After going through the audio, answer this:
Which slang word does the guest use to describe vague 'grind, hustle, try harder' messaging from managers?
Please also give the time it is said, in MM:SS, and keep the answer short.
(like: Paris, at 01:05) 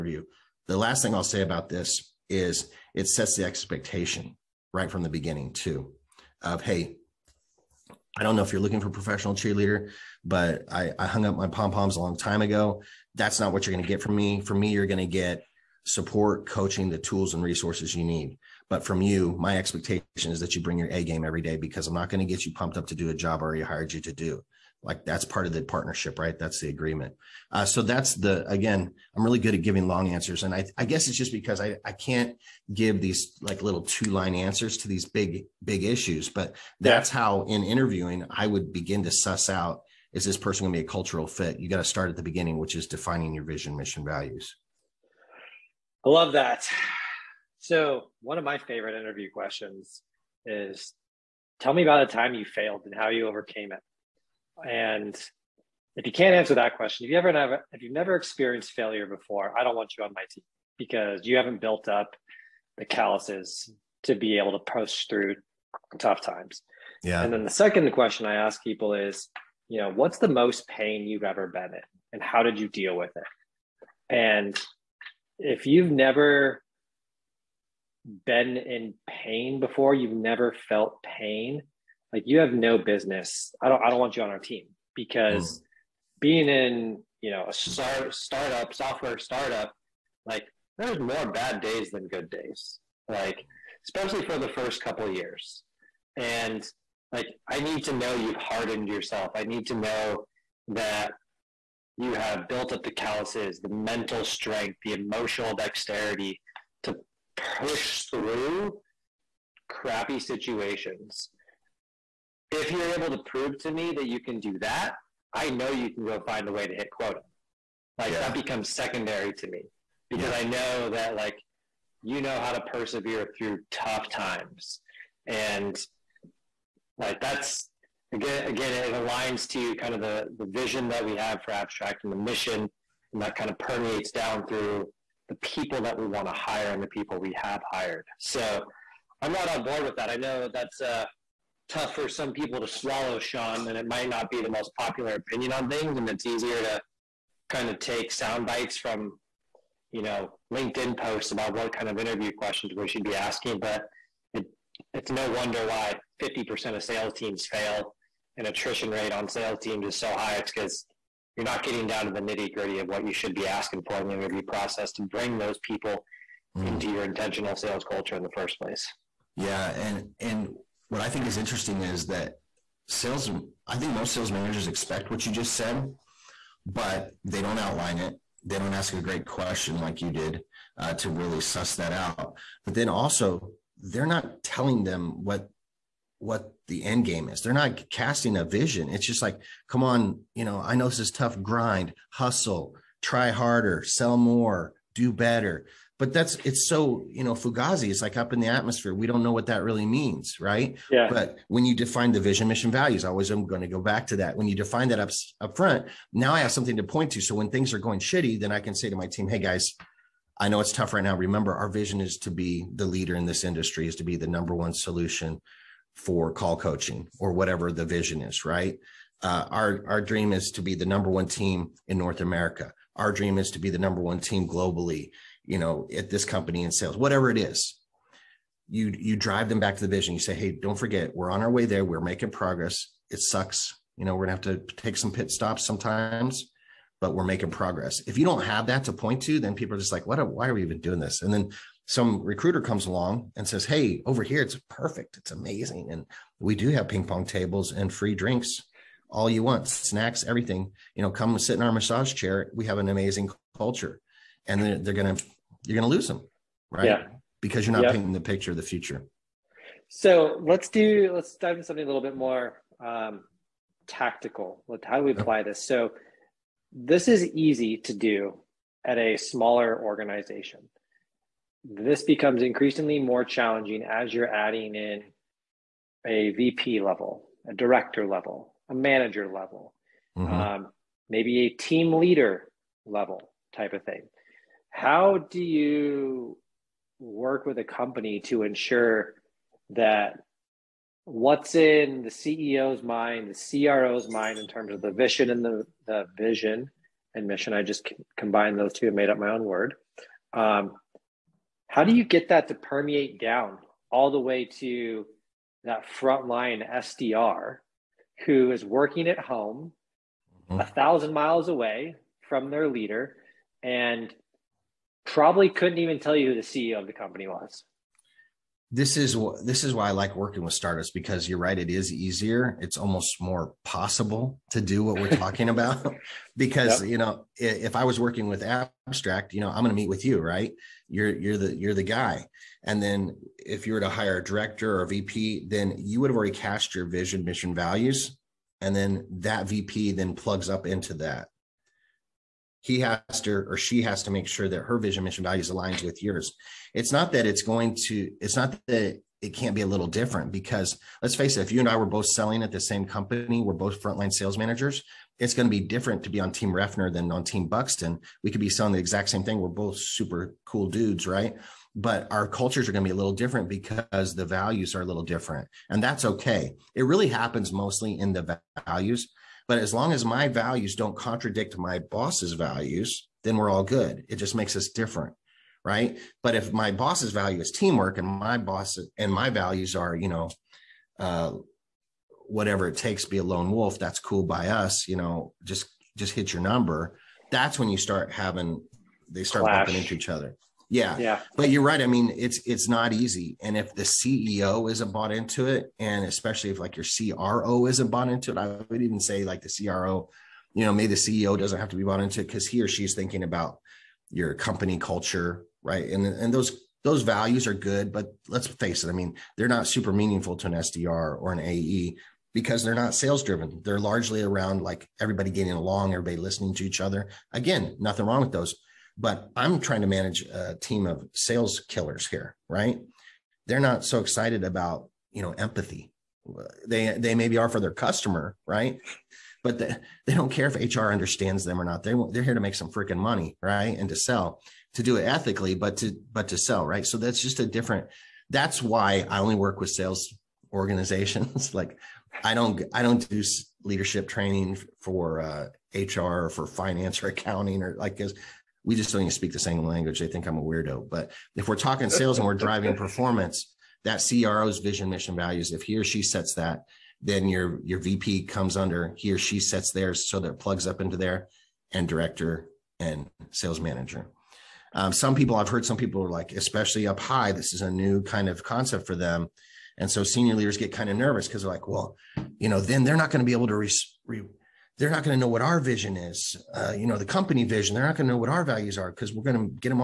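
fugazi, at 03:17.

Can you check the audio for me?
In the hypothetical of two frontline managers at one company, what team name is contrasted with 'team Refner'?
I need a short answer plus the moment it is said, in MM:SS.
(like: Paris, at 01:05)
team Buxton, at 05:57.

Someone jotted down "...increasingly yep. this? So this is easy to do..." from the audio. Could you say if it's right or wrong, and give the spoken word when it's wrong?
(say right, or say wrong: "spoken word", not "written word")
wrong: "apply", not "increasingly".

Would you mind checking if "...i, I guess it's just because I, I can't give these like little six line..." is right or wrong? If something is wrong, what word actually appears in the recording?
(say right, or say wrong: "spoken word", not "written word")
wrong: "two", not "six".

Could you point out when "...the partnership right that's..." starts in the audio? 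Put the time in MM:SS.
00:25.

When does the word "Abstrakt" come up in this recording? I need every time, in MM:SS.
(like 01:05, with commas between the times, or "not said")
02:11, 05:28.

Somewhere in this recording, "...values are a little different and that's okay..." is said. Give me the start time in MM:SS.
06:04.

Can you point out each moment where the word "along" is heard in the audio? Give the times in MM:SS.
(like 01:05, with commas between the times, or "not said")
04:02, 06:55.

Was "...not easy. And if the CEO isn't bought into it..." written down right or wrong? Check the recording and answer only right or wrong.
right.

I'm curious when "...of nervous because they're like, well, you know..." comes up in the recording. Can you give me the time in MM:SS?
07:50.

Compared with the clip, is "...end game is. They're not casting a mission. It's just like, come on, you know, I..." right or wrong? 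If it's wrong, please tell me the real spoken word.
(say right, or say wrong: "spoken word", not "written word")
wrong: "vision", not "mission".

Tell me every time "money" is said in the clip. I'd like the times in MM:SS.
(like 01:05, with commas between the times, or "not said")
07:12.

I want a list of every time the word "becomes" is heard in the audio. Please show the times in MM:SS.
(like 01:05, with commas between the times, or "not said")
01:58, 04:32.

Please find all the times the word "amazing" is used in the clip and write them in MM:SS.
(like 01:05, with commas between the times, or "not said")
04:05, 04:12.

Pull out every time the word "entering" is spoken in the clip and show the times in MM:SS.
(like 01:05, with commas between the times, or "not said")
not said.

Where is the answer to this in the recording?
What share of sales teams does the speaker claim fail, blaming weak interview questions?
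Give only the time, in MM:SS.
02:36.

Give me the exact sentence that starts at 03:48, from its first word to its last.
You you drive them back to the vision.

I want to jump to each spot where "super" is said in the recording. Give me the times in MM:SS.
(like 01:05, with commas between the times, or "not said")
05:59, 06:49.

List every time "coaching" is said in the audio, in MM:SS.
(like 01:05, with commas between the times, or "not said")
00:16, 03:36.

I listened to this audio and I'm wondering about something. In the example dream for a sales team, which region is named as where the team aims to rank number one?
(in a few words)
North America.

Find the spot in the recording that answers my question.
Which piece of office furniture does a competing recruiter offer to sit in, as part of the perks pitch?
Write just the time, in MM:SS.
04:11.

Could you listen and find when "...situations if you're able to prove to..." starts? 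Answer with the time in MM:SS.
01:50.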